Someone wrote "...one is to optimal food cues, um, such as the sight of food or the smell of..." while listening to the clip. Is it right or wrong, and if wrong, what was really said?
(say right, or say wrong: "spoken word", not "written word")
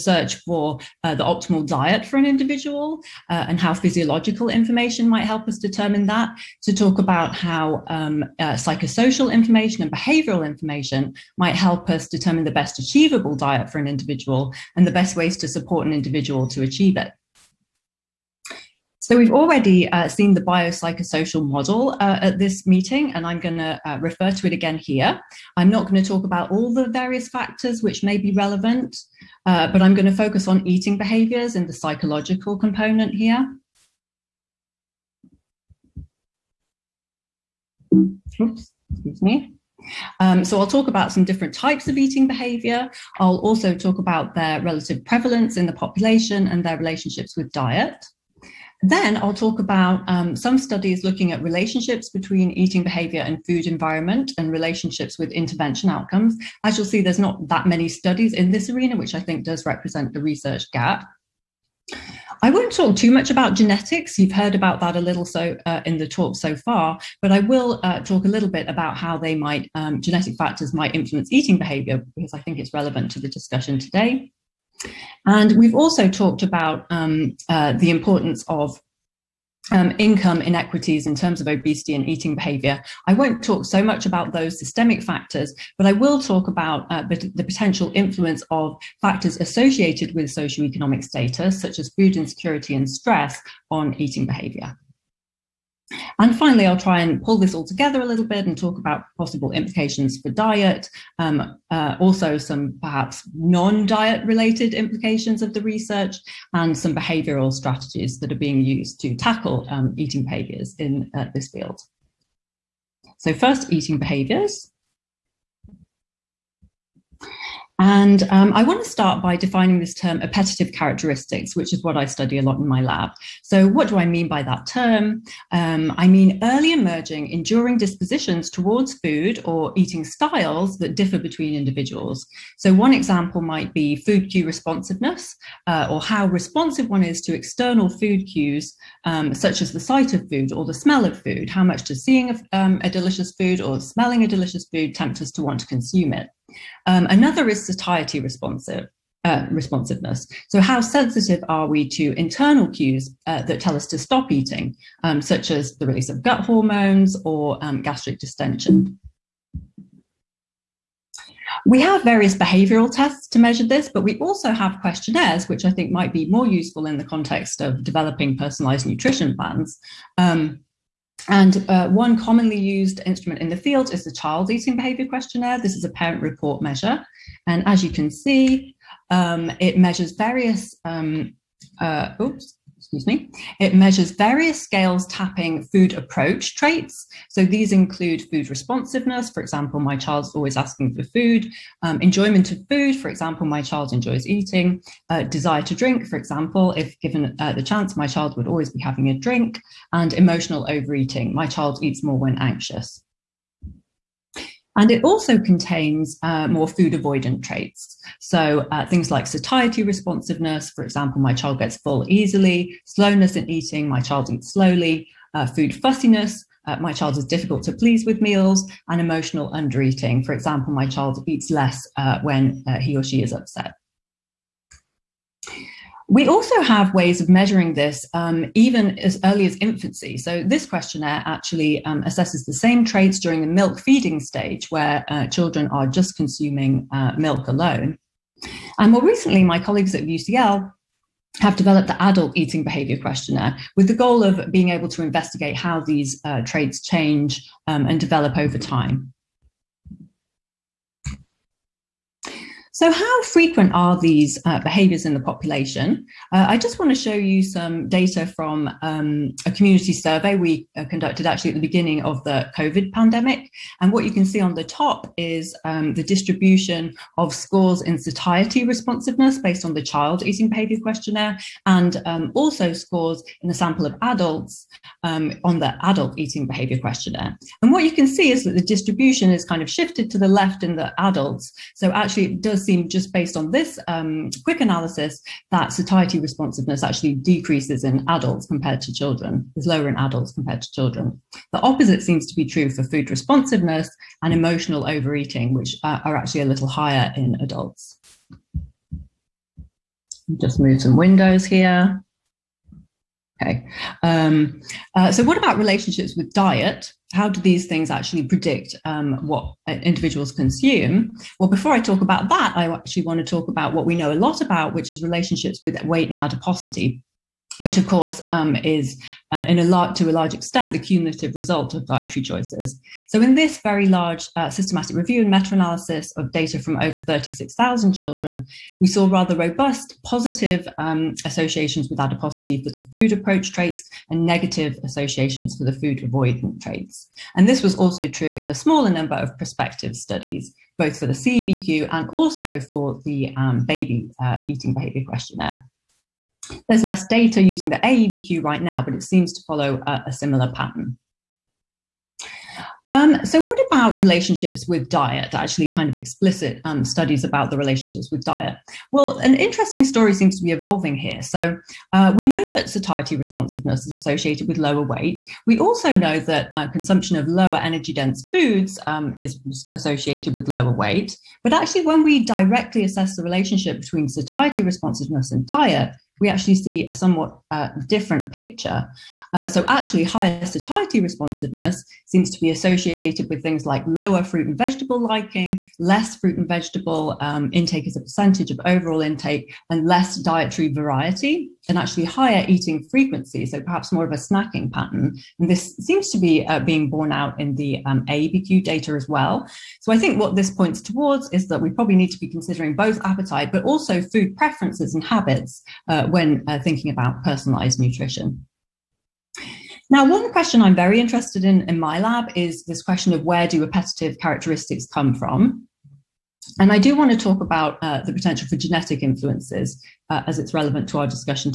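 wrong: "external", not "optimal".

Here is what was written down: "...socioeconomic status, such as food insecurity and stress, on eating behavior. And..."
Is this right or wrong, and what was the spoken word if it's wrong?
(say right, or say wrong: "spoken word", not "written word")
right.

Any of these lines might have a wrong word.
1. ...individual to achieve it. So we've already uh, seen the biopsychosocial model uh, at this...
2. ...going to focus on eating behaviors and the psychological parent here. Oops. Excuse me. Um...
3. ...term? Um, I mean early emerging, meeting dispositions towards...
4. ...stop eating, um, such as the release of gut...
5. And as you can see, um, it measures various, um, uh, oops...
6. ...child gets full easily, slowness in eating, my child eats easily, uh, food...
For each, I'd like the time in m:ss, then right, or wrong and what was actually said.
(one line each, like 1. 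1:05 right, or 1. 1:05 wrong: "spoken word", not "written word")
1. 0:15 right
2. 0:29 wrong: "component", not "parent"
3. 2:04 wrong: "enduring", not "meeting"
4. 2:33 right
5. 2:57 right
6. 3:31 wrong: "slowly", not "easily".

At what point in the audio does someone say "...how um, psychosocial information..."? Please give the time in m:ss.
0:07.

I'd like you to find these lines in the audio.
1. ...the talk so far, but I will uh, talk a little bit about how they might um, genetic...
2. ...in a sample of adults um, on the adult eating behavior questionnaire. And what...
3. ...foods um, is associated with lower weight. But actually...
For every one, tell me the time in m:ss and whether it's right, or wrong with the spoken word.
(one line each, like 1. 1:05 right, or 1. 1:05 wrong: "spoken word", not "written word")
1. 1:05 right
2. 4:33 right
3. 6:08 right.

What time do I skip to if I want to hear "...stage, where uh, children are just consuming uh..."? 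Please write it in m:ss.
3:54.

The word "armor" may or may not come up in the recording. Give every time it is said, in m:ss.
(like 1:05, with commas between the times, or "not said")
not said.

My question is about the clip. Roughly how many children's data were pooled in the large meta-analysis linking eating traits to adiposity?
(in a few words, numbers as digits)
over 36,000.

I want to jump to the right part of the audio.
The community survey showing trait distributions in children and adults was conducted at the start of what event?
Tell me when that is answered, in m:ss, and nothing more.
4:22.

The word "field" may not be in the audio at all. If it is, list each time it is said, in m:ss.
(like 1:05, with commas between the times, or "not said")
1:51, 2:53.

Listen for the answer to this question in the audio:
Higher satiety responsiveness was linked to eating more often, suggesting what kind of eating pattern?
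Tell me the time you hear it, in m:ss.
6:34.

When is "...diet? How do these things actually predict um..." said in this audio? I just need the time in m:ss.
5:06.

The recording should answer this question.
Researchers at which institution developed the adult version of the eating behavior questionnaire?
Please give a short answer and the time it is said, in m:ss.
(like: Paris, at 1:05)
UCL, at 4:00.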